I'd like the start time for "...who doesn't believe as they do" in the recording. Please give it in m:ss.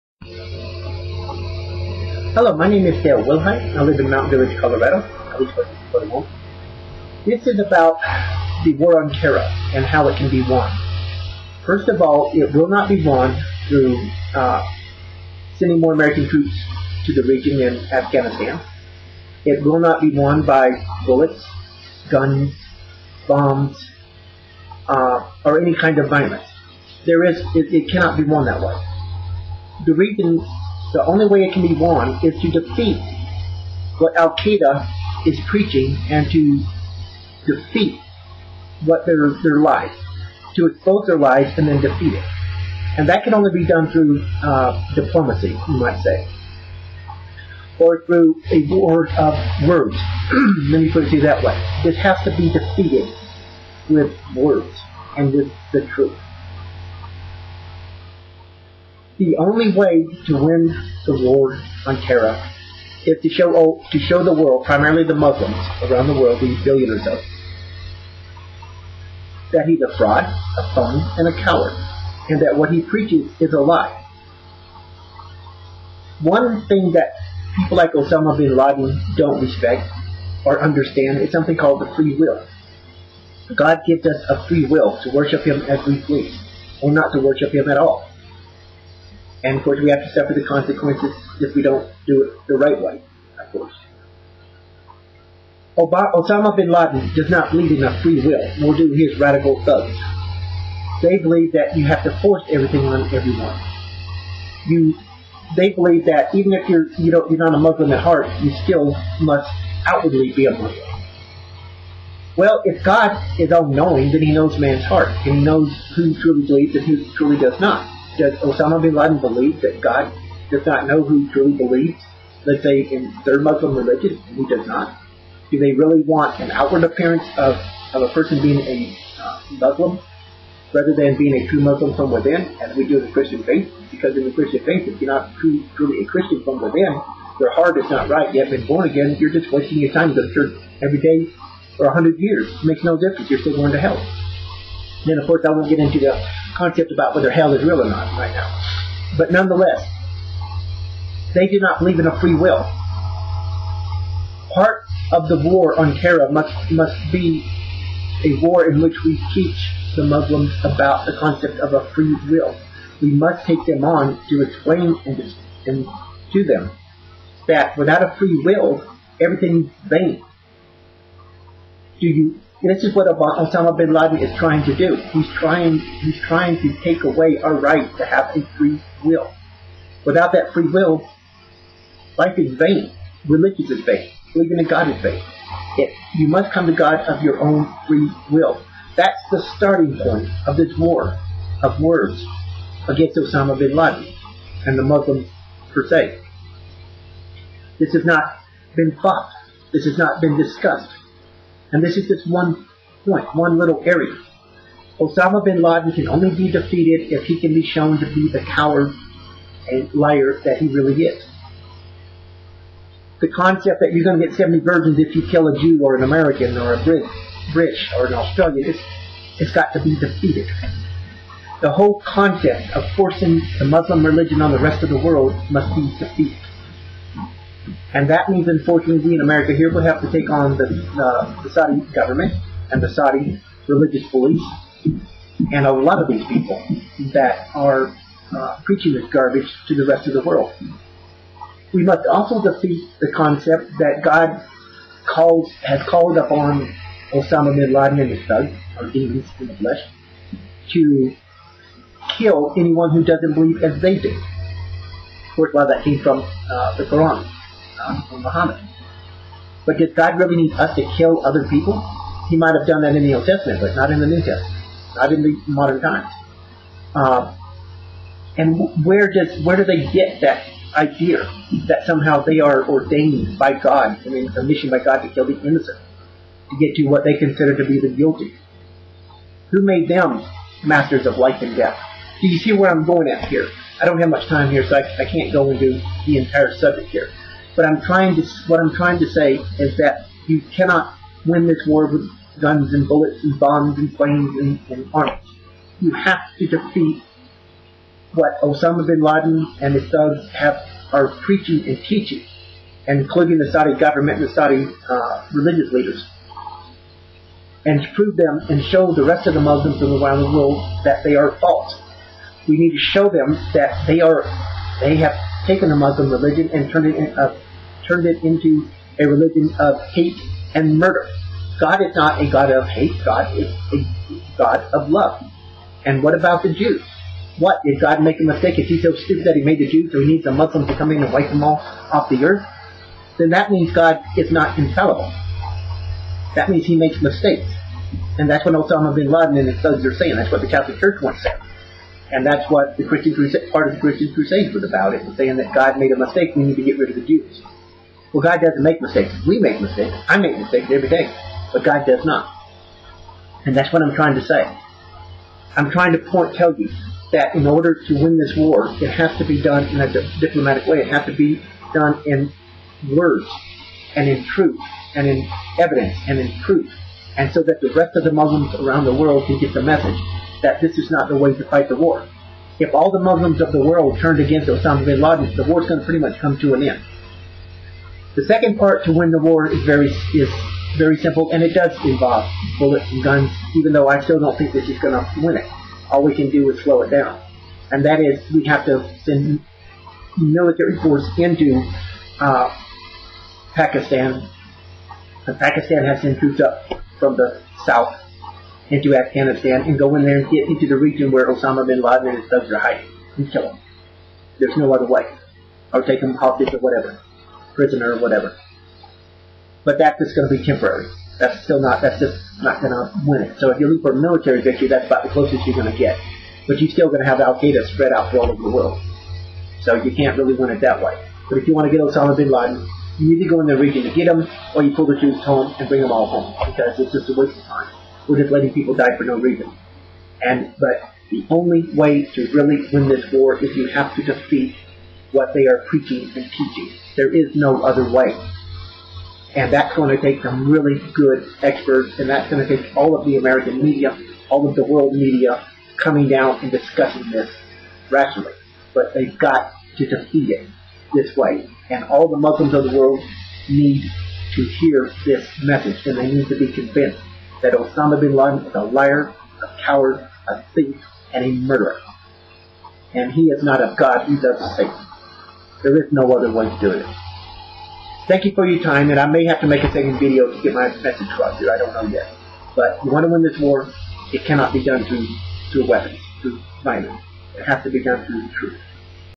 4:12.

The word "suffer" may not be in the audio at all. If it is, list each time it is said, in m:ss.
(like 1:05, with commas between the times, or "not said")
1:30.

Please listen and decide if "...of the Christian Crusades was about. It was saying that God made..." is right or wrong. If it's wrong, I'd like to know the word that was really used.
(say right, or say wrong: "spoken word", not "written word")
right.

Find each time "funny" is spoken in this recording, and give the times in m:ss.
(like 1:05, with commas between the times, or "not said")
not said.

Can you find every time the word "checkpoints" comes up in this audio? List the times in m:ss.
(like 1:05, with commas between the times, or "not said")
not said.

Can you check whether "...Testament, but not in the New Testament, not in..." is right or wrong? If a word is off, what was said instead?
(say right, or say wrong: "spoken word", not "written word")
right.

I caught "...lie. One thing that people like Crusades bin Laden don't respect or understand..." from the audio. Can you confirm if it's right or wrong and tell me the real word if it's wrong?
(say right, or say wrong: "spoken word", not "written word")
wrong: "Osama", not "Crusades".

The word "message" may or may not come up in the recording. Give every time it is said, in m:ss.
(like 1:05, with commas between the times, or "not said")
6:09, 7:35, 7:50.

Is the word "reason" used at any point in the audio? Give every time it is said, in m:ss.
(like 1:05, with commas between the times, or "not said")
0:29, 7:09.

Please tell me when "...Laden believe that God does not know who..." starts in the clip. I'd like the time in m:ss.
1:58.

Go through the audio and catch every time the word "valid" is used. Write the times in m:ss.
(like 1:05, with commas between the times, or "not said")
not said.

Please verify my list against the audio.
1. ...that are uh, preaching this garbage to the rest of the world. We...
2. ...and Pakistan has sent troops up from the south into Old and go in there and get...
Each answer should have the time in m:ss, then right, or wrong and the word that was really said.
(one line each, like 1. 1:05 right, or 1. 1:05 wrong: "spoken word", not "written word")
1. 3:57 right
2. 6:35 wrong: "Afghanistan", not "Old".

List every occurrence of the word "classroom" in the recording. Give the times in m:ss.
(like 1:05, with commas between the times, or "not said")
not said.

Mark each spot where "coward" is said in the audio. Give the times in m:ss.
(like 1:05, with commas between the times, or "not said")
1:11, 3:28, 7:39.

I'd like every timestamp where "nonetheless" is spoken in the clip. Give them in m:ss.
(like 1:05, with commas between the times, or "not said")
2:29.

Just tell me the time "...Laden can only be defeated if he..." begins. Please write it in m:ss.
3:25.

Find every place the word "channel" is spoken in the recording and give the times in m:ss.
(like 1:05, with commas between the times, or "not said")
not said.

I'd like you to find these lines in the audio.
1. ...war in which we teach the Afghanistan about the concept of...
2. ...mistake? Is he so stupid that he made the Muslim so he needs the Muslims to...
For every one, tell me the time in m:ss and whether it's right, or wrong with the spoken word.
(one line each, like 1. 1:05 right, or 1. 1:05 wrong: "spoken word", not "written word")
1. 2:38 wrong: "Muslims", not "Afghanistan"
2. 5:28 wrong: "Jews", not "Muslim".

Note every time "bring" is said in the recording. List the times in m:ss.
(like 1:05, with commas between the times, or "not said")
7:05.